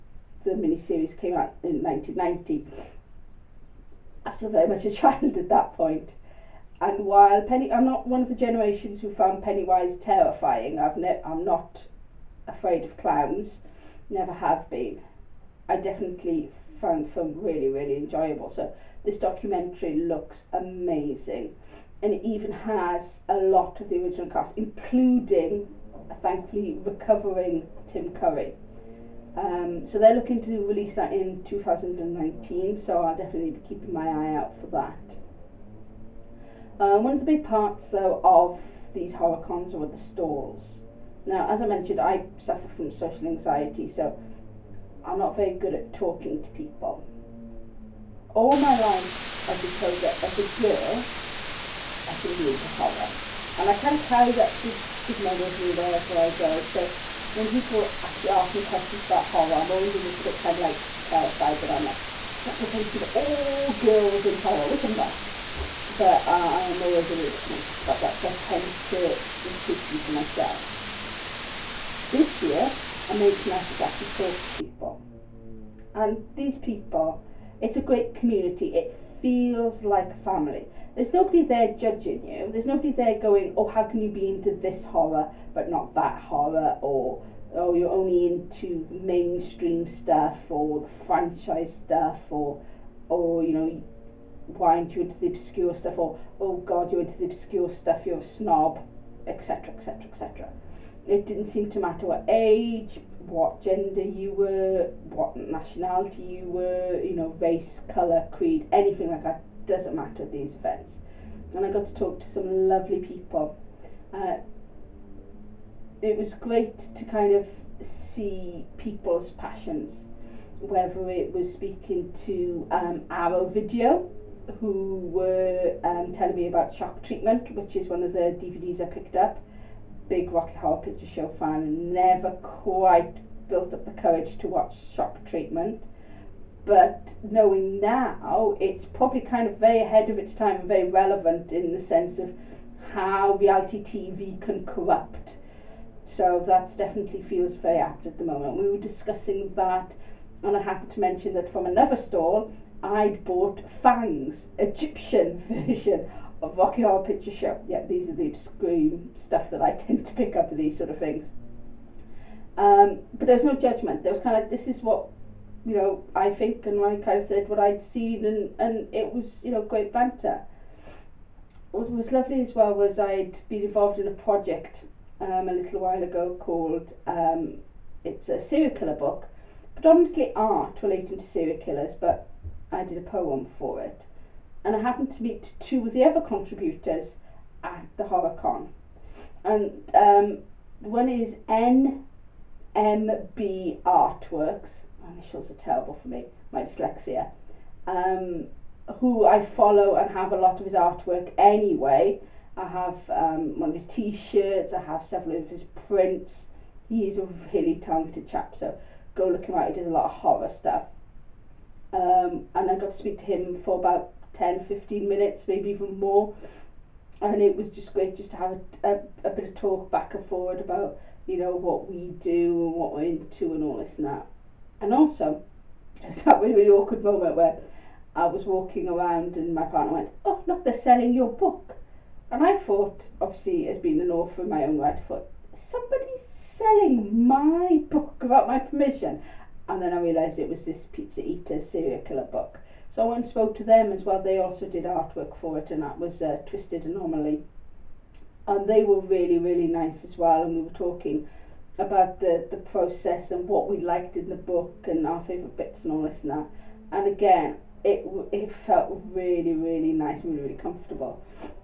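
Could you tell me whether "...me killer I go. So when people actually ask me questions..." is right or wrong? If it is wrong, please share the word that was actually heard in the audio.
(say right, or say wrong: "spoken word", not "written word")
wrong: "wherever", not "killer".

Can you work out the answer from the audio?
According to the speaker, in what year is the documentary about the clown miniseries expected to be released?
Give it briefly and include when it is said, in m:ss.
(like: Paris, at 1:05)
2019, at 0:31.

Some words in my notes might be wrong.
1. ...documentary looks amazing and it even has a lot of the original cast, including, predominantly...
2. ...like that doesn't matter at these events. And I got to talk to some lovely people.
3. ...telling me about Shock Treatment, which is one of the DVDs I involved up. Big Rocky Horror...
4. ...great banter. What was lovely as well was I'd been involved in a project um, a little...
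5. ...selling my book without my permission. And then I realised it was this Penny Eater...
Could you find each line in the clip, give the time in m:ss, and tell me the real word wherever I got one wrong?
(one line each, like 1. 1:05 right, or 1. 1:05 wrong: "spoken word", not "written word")
1. 0:19 wrong: "thankfully", not "predominantly"
2. 1:49 right
3. 2:06 wrong: "picked", not "involved"
4. 2:49 right
5. 3:56 wrong: "Pizza", not "Penny".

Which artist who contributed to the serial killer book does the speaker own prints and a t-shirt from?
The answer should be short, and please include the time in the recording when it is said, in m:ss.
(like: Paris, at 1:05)
NMB Artworks, at 3:11.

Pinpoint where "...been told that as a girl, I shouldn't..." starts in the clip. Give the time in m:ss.
0:49.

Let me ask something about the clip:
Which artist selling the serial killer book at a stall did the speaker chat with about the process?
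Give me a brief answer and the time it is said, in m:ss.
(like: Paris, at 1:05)
Twisted Anomaly, at 4:06.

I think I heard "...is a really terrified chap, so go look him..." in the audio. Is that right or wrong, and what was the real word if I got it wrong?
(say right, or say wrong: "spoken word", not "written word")
wrong: "talented", not "terrified".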